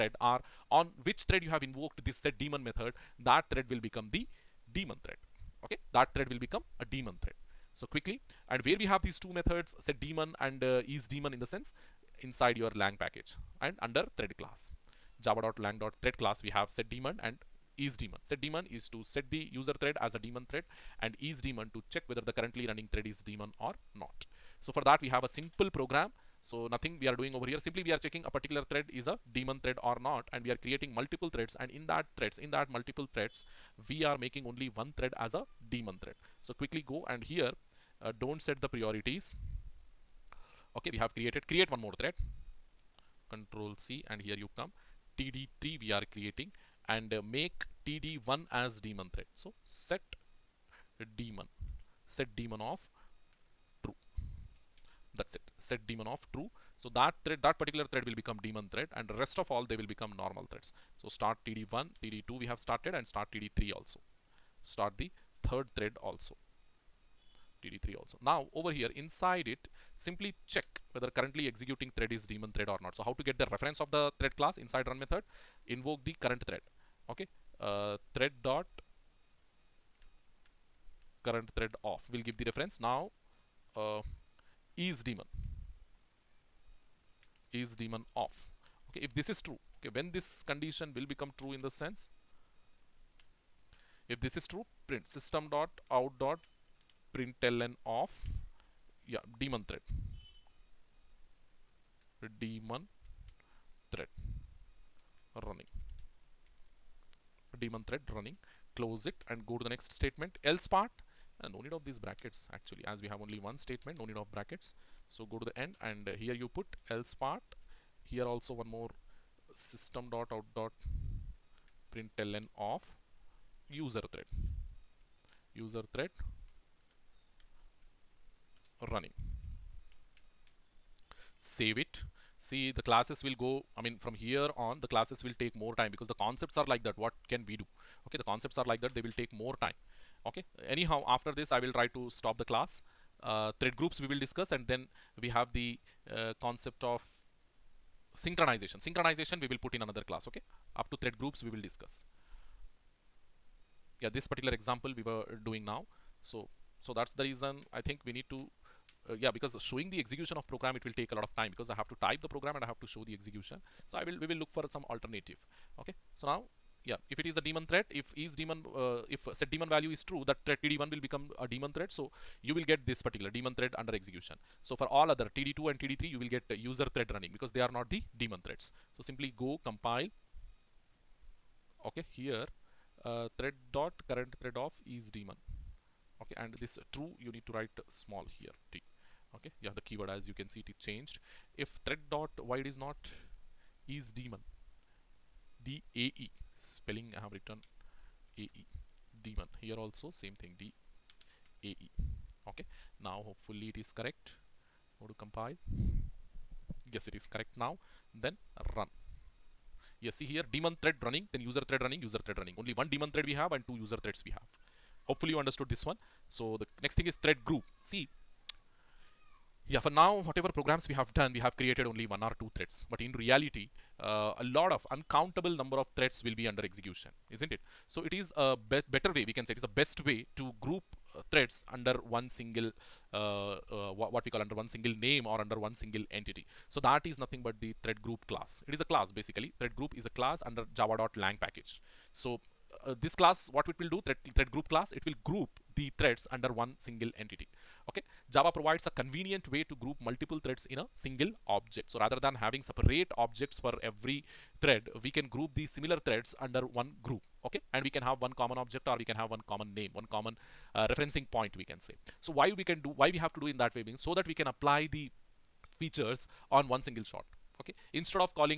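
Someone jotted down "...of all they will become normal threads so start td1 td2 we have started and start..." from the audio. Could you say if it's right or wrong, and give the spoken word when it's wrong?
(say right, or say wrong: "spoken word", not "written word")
right.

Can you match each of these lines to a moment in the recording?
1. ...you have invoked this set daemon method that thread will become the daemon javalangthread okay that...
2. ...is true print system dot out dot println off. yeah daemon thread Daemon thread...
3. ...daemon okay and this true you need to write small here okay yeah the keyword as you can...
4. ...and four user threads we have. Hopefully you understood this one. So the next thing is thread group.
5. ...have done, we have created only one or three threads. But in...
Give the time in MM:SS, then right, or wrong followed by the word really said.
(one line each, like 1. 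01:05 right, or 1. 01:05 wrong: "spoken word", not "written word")
1. 00:01 wrong: "thread", not "javalangthread"
2. 01:34 right
3. 03:05 right
4. 03:33 wrong: "two", not "four"
5. 03:40 wrong: "two", not "three".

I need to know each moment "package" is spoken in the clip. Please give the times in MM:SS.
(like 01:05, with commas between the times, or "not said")
00:12, 04:01.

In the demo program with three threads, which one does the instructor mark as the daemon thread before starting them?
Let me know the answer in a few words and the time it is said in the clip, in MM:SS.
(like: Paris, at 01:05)
td1, at 00:47.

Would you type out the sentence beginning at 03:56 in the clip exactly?
So that is nothing but the thread group class.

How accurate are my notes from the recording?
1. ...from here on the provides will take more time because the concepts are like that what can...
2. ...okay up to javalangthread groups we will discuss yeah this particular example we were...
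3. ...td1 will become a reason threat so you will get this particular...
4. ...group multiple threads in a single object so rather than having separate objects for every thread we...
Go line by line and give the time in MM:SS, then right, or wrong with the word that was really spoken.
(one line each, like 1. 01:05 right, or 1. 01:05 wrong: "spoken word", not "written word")
1. 02:13 wrong: "classes", not "provides"
2. 02:30 wrong: "thread", not "javalangthread"
3. 02:50 wrong: "daemon", not "reason"
4. 04:09 right.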